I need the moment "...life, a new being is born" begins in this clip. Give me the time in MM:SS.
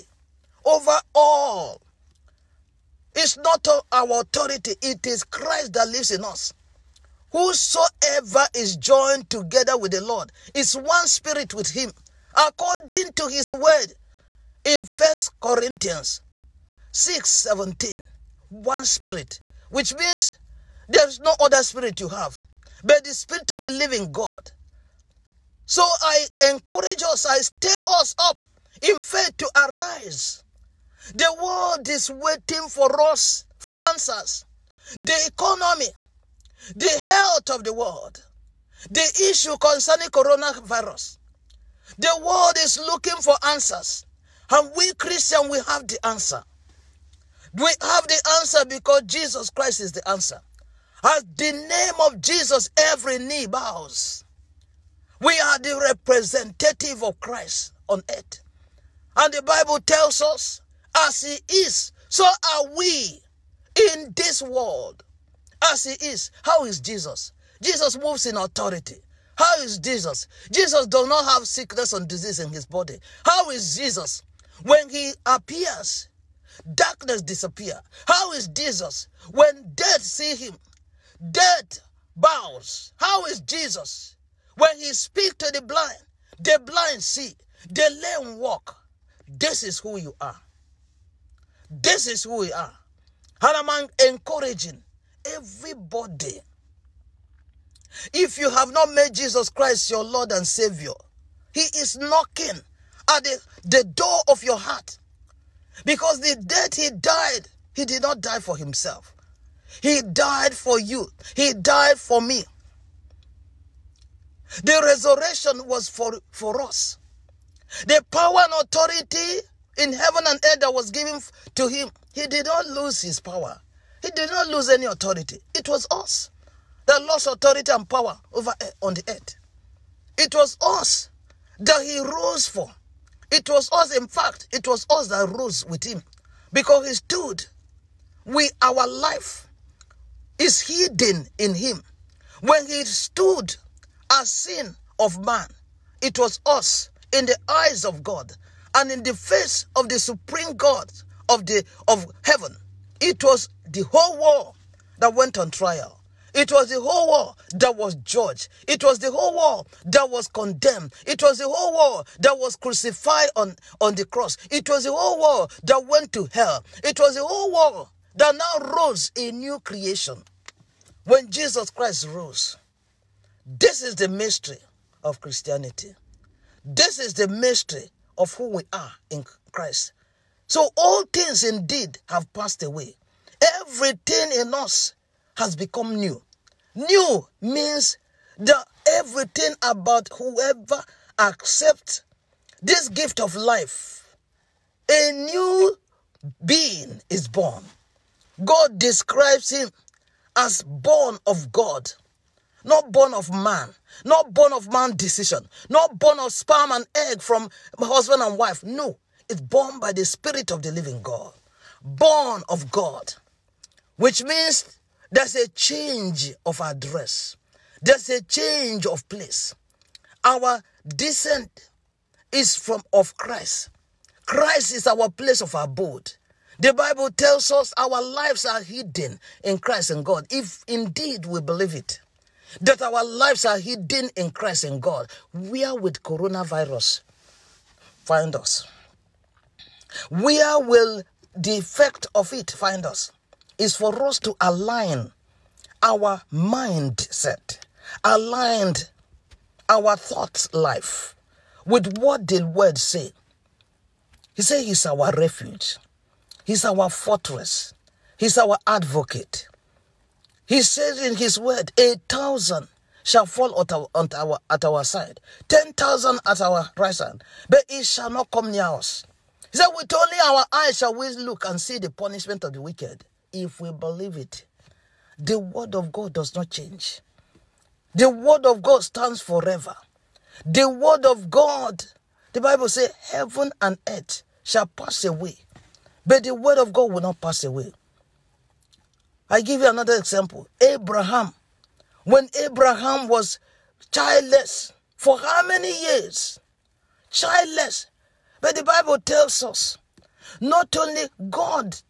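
03:13.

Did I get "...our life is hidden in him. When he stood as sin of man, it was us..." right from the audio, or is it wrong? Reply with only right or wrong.
right.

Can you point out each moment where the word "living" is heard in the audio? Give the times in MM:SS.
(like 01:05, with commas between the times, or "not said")
00:23, 03:30.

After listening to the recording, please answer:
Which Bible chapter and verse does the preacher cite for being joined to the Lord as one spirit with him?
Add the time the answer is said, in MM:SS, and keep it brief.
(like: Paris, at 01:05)
First Corinthians 6:17, at 00:14.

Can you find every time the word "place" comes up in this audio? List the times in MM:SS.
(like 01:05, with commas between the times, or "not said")
03:39, 03:45.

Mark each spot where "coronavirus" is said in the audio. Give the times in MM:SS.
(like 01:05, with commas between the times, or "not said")
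00:40, 03:56.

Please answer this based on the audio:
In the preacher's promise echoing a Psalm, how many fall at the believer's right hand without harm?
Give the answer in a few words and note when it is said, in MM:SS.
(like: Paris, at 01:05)
10,000, at 04:25.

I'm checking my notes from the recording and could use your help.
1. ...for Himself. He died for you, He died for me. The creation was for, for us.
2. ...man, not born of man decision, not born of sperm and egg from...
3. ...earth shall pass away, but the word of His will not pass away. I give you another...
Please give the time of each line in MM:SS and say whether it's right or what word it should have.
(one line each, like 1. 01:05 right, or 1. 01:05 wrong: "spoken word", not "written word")
1. 01:48 wrong: "resurrection", not "creation"
2. 03:23 right
3. 04:43 wrong: "God", not "His".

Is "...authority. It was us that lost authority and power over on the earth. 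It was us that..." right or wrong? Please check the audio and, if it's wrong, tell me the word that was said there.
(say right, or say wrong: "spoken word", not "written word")
right.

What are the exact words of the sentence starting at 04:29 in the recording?
He said, With only our eyes shall we look and see the punishment of the wicked if we believe it.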